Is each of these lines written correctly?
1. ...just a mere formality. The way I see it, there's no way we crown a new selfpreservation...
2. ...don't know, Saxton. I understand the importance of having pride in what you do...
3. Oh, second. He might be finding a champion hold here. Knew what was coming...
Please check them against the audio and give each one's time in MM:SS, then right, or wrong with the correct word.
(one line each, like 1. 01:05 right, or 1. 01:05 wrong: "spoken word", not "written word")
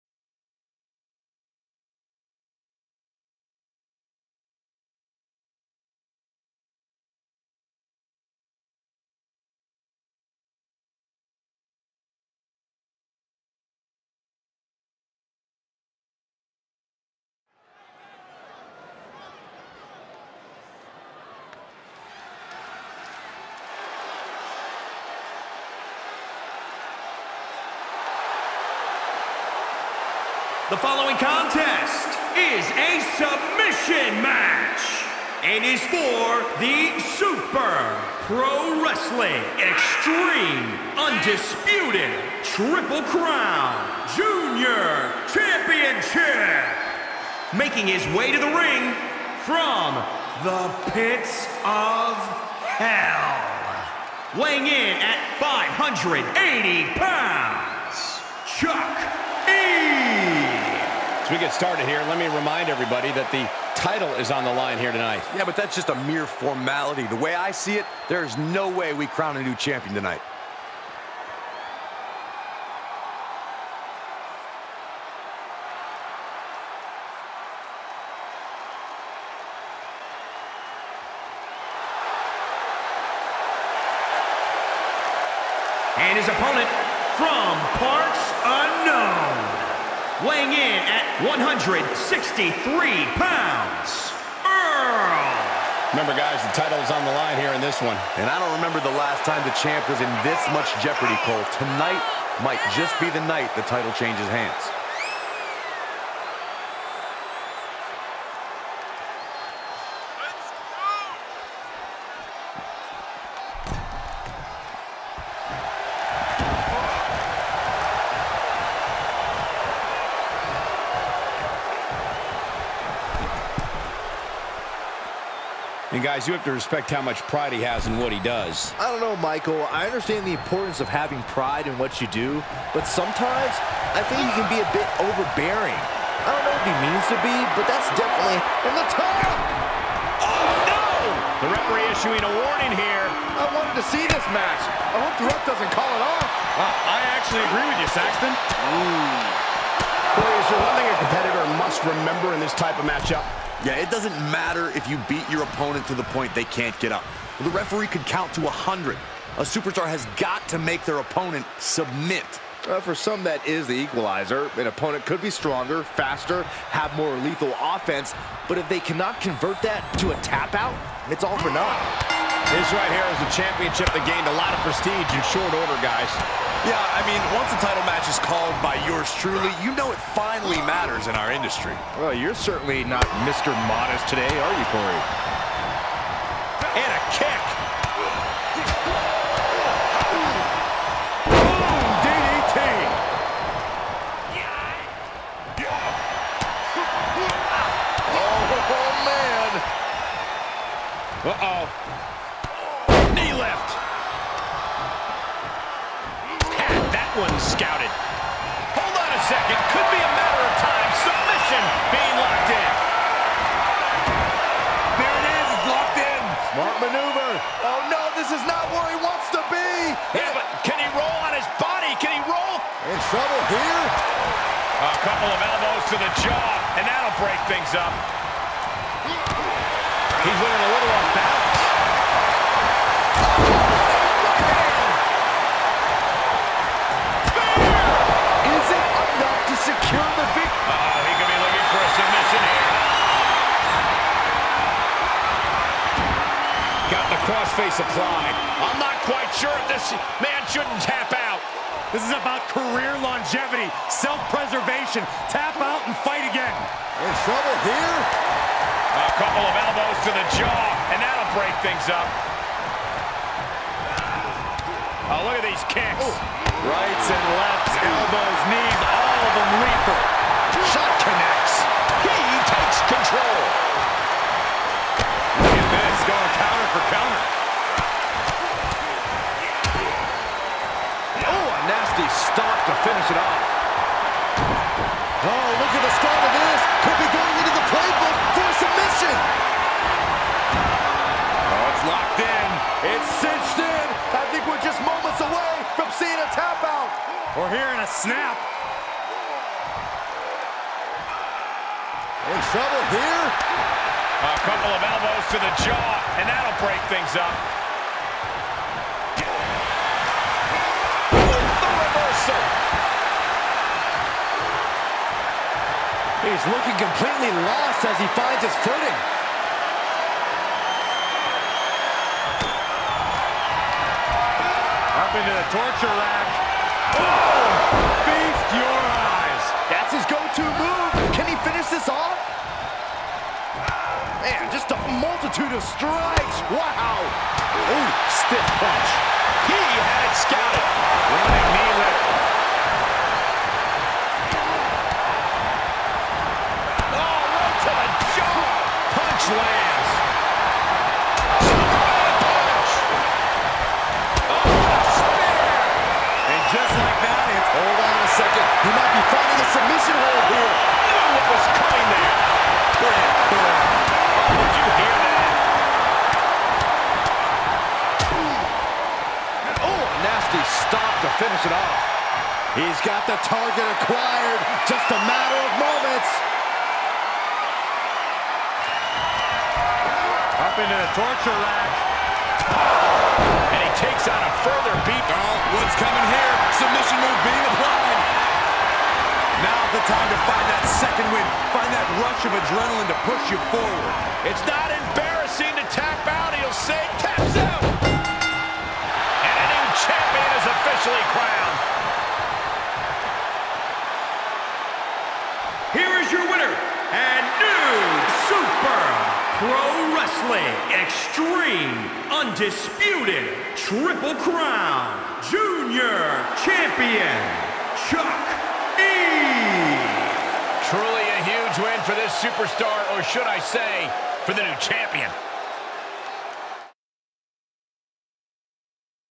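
1. 01:05 wrong: "champion", not "selfpreservation"
2. 02:08 wrong: "Michael", not "Saxton"
3. 05:54 wrong: "submission", not "champion".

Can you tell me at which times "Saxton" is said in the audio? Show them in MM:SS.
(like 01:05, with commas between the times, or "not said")
02:27.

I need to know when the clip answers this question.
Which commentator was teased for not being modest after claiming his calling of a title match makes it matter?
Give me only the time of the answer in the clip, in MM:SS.
03:04.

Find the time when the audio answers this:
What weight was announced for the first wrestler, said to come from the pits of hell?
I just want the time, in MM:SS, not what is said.
00:55.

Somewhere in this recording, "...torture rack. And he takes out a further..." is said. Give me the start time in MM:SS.
06:20.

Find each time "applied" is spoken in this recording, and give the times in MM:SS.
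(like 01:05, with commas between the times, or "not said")
04:07, 06:27.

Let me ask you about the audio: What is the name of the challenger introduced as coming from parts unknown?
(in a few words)
Earl.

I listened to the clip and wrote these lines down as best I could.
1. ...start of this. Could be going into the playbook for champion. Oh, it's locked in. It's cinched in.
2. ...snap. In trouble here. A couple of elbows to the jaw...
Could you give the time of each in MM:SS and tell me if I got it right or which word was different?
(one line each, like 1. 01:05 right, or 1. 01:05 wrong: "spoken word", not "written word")
1. 04:45 wrong: "submission", not "champion"
2. 04:57 right.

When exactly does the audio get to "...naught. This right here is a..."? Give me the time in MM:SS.
02:51.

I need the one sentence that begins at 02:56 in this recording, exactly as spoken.
Yeah, I mean, once a title match is called by yours truly, you know it finally matters in our industry.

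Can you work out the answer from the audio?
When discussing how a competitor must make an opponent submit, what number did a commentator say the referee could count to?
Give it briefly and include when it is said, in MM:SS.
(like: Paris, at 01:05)
100, at 02:38.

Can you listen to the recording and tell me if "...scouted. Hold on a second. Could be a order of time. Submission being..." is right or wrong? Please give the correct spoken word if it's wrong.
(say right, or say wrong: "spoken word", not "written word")
wrong: "matter", not "order".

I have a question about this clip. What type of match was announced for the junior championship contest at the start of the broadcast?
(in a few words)
Submission match.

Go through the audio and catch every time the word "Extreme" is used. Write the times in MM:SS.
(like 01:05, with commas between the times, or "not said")
00:39, 06:50.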